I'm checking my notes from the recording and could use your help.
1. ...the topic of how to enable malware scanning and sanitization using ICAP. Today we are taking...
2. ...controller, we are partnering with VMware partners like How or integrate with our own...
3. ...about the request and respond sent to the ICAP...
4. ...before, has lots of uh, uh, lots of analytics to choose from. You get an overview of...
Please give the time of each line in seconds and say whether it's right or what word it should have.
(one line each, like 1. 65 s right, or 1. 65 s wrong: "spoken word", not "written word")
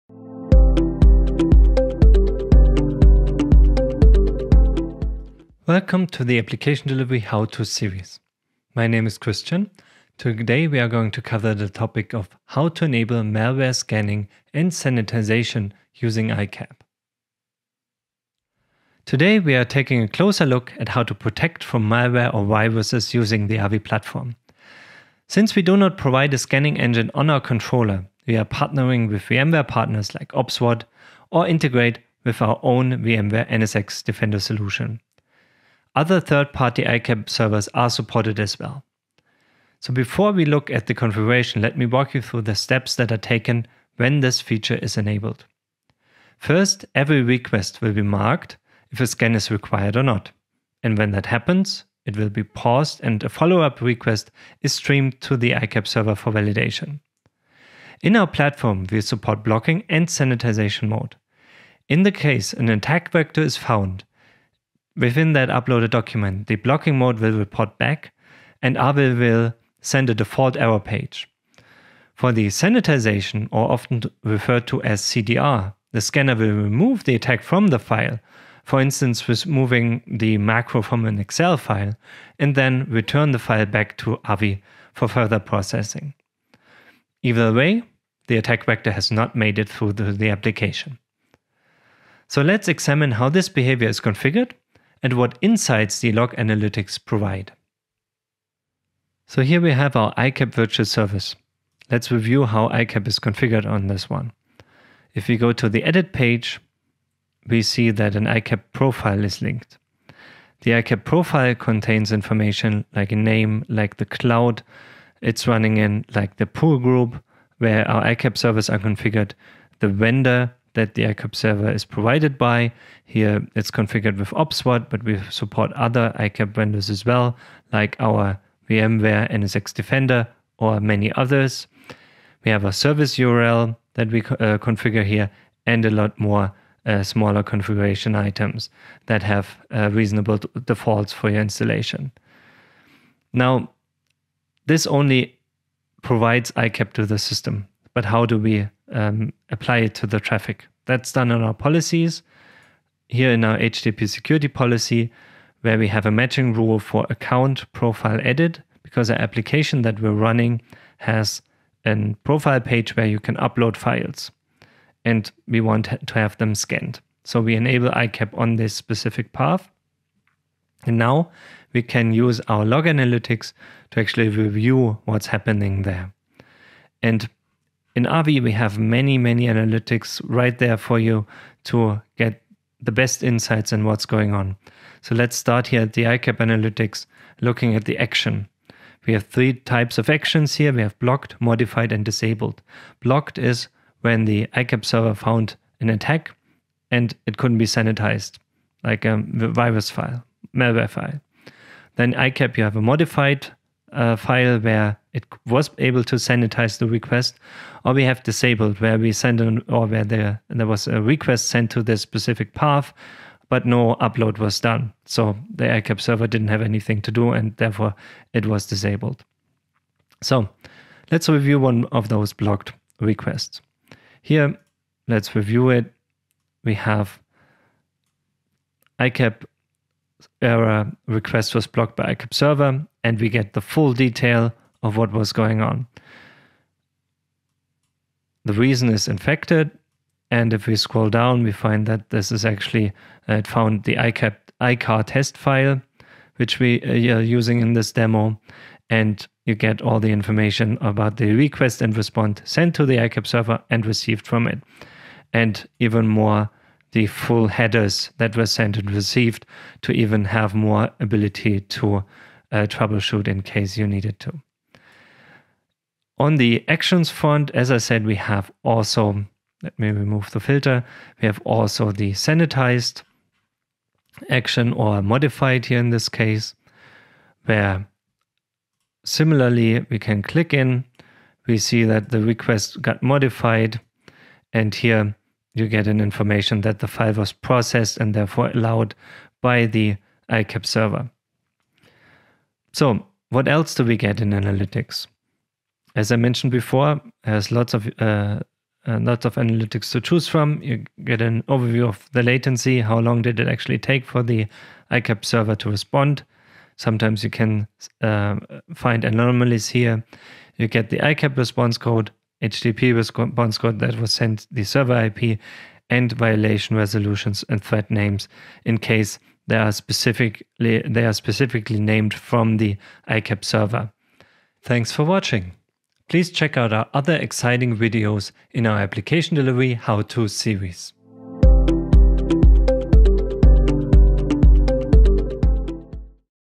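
1. 11 s right
2. 27 s wrong: "OPSWAT", not "How"
3. 250 s right
4. 296 s right.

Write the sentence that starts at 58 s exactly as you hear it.
In our platform, we support blocking and sanitization mode.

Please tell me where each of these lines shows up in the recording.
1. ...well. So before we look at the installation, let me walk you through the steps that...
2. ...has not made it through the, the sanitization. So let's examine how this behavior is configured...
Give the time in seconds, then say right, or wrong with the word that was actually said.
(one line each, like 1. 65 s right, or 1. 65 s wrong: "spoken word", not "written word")
1. 38 s wrong: "configuration", not "installation"
2. 88 s wrong: "application", not "sanitization".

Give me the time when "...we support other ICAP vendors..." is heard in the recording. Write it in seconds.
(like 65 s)
125 s.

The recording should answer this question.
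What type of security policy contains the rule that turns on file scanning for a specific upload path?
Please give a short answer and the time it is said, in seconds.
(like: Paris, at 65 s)
HTTP security policy, at 153 s.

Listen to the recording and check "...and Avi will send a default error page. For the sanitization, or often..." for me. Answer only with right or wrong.
right.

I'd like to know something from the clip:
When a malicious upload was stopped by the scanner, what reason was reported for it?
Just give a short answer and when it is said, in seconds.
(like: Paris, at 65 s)
Infected, at 239 s.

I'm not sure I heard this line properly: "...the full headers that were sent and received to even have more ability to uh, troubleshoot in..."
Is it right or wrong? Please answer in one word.
right.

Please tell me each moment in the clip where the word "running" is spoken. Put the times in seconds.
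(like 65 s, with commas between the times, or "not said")
115 s, 160 s.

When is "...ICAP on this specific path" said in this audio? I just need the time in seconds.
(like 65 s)
167 s.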